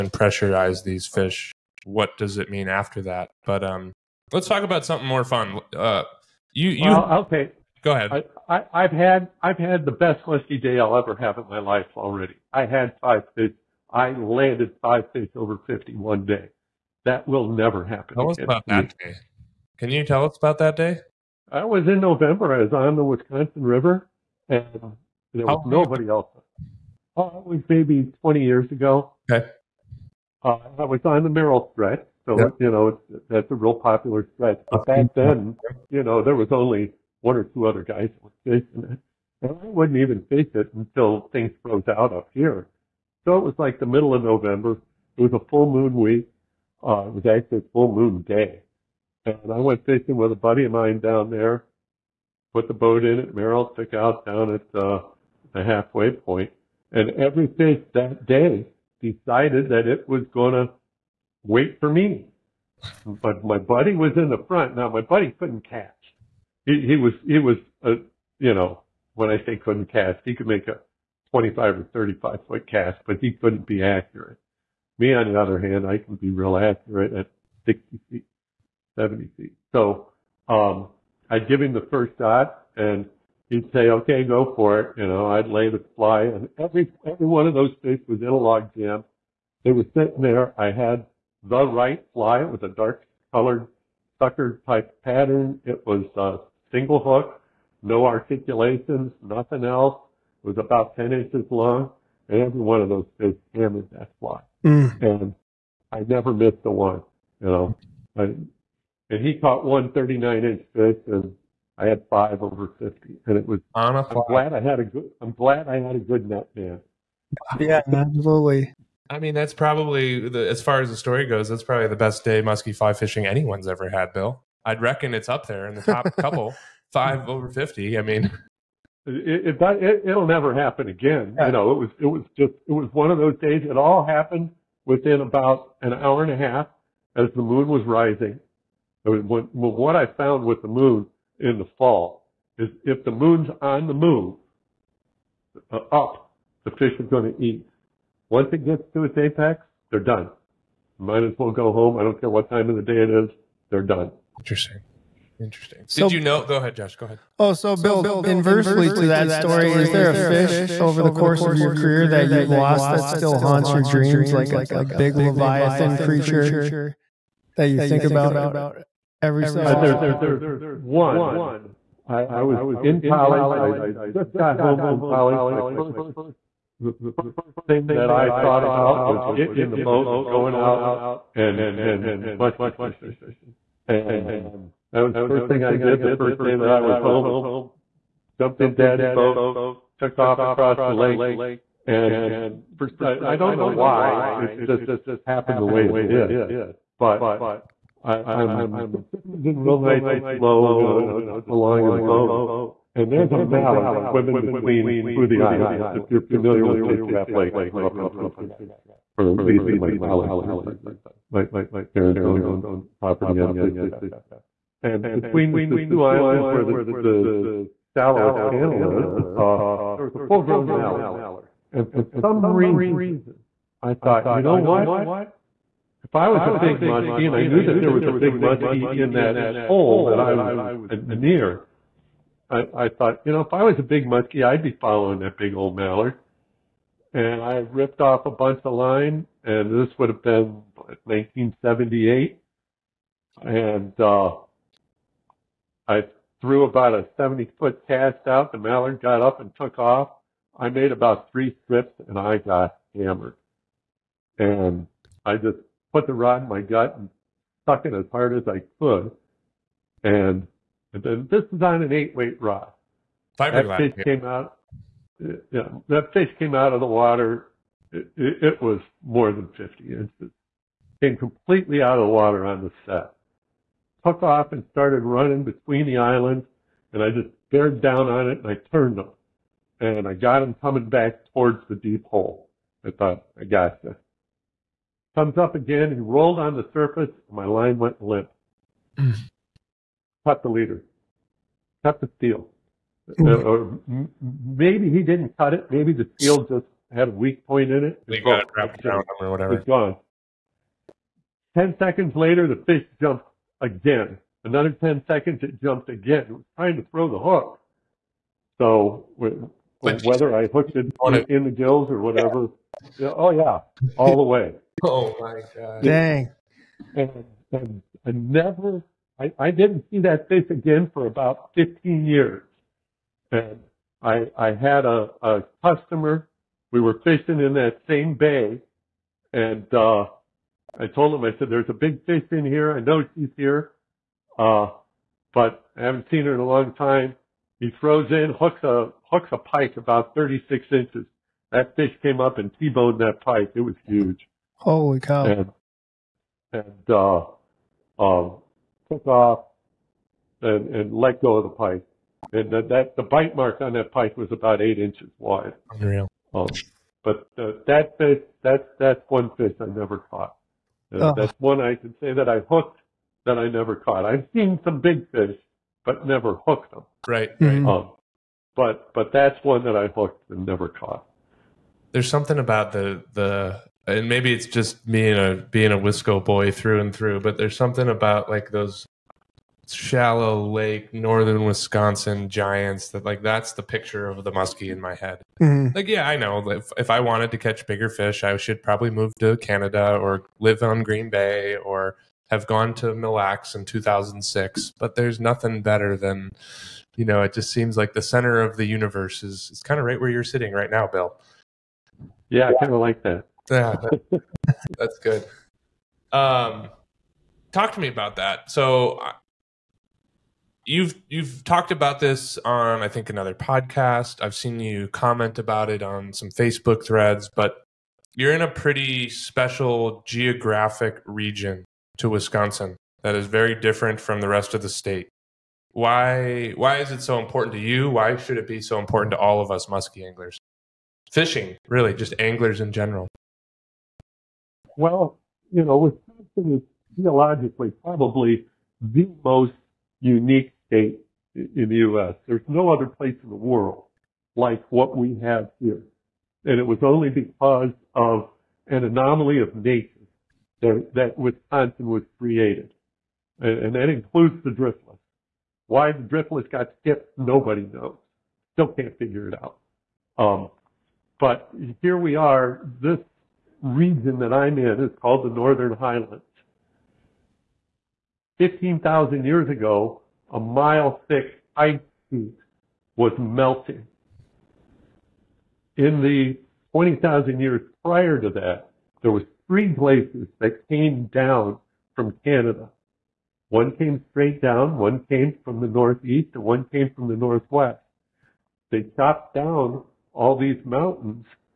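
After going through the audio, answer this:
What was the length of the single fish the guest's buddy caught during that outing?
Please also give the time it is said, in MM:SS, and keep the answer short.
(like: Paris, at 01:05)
39 inches, at 01:49.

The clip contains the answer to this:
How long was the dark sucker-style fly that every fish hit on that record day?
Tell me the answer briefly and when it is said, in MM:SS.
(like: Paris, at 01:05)
About 10 inches, at 01:40.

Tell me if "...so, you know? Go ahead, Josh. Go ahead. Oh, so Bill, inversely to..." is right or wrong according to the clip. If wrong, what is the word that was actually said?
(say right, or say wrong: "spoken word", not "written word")
right.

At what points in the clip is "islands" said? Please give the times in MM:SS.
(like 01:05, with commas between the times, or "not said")
03:25, 03:36, 04:35.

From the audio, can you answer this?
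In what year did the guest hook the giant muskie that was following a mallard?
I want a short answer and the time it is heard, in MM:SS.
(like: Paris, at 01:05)
1978, at 04:01.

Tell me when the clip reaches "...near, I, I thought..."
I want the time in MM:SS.
03:51.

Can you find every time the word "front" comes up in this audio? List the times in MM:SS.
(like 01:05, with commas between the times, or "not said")
01:04.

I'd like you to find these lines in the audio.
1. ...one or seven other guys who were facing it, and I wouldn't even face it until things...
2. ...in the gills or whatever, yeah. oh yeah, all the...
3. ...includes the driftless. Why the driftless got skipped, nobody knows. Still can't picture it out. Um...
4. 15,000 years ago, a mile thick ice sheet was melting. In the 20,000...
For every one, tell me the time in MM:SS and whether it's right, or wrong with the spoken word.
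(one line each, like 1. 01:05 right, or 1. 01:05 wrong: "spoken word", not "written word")
1. 00:37 wrong: "two", not "seven"
2. 05:11 right
3. 07:33 wrong: "figure", not "picture"
4. 07:48 right.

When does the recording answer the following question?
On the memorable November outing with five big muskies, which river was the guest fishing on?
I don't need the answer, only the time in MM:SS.
00:23.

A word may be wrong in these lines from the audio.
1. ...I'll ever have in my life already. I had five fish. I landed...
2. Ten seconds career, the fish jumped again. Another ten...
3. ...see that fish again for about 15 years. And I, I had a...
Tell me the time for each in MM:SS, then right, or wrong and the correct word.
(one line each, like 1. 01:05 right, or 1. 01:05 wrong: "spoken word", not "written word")
1. 00:10 right
2. 05:01 wrong: "later", not "career"
3. 05:19 right.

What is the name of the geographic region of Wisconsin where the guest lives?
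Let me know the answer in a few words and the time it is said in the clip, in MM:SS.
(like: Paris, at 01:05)
Northern Highlands, at 07:45.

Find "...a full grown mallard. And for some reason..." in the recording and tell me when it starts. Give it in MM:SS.
03:40.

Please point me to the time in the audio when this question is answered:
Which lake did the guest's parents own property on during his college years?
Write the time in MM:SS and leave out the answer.
03:26.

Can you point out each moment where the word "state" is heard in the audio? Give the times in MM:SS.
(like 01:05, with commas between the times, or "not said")
07:04, 07:20.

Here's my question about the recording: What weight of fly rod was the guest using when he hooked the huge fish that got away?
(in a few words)
Eight weight.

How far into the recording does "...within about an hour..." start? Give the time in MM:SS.
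02:14.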